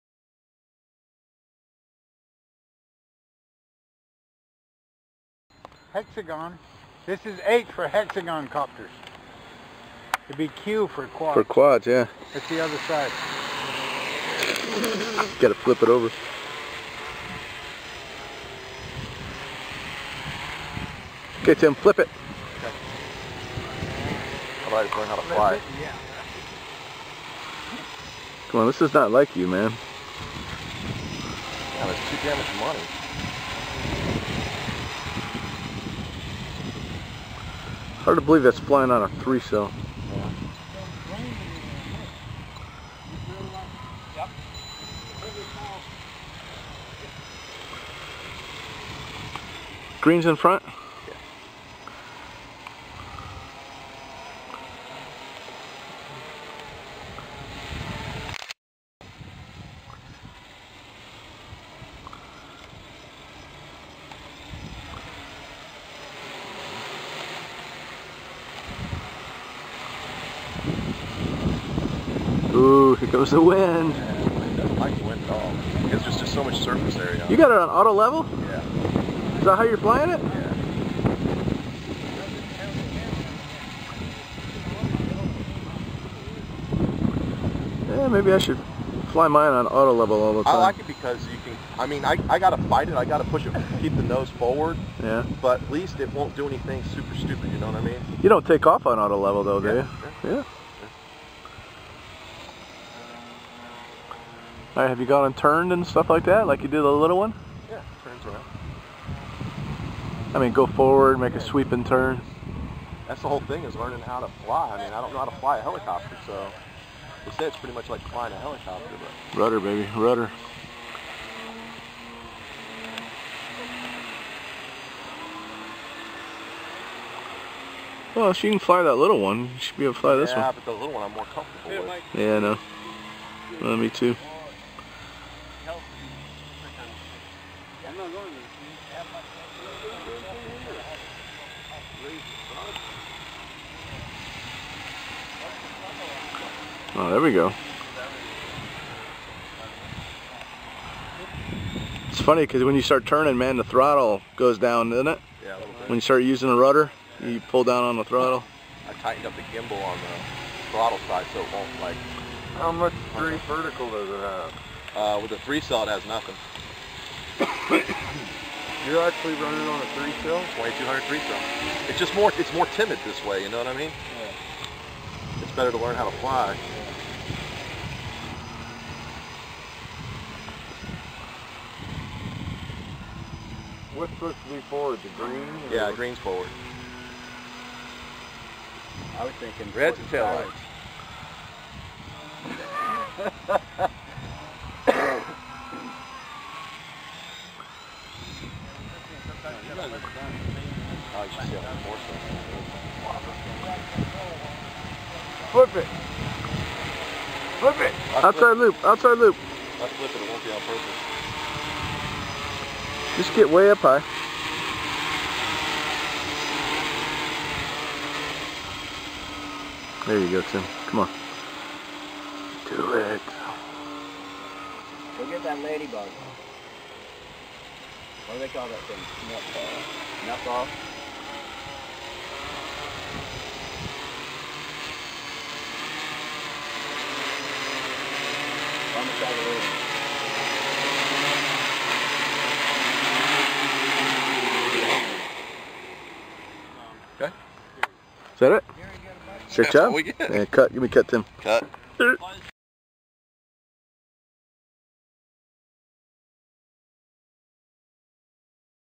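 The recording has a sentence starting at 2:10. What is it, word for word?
Yeah, but the little one I'm more comfortable with.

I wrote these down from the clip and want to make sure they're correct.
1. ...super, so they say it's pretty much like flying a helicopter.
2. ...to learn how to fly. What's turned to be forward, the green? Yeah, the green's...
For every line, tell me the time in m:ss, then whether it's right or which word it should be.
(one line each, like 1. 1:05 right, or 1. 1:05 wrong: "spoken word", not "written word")
1. 1:55 wrong: "helicopter", not "super"
2. 2:55 wrong: "supposed", not "turned".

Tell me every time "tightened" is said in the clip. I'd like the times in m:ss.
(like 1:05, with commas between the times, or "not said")
2:39.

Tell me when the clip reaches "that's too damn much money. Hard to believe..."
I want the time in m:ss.
0:31.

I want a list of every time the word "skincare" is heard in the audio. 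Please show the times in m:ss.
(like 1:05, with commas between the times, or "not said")
not said.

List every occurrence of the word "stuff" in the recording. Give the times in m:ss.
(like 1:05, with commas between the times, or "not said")
1:45.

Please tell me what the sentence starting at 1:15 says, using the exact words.
Because there's just so much surface area.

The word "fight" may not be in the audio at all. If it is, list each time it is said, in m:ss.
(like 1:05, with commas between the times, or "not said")
1:32.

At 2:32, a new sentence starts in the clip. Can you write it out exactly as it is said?
It's funny because when you start turning, man, the throttle goes down, doesn't it?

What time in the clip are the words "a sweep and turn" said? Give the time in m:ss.
1:51.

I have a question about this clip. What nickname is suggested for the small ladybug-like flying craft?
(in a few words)
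Nutball.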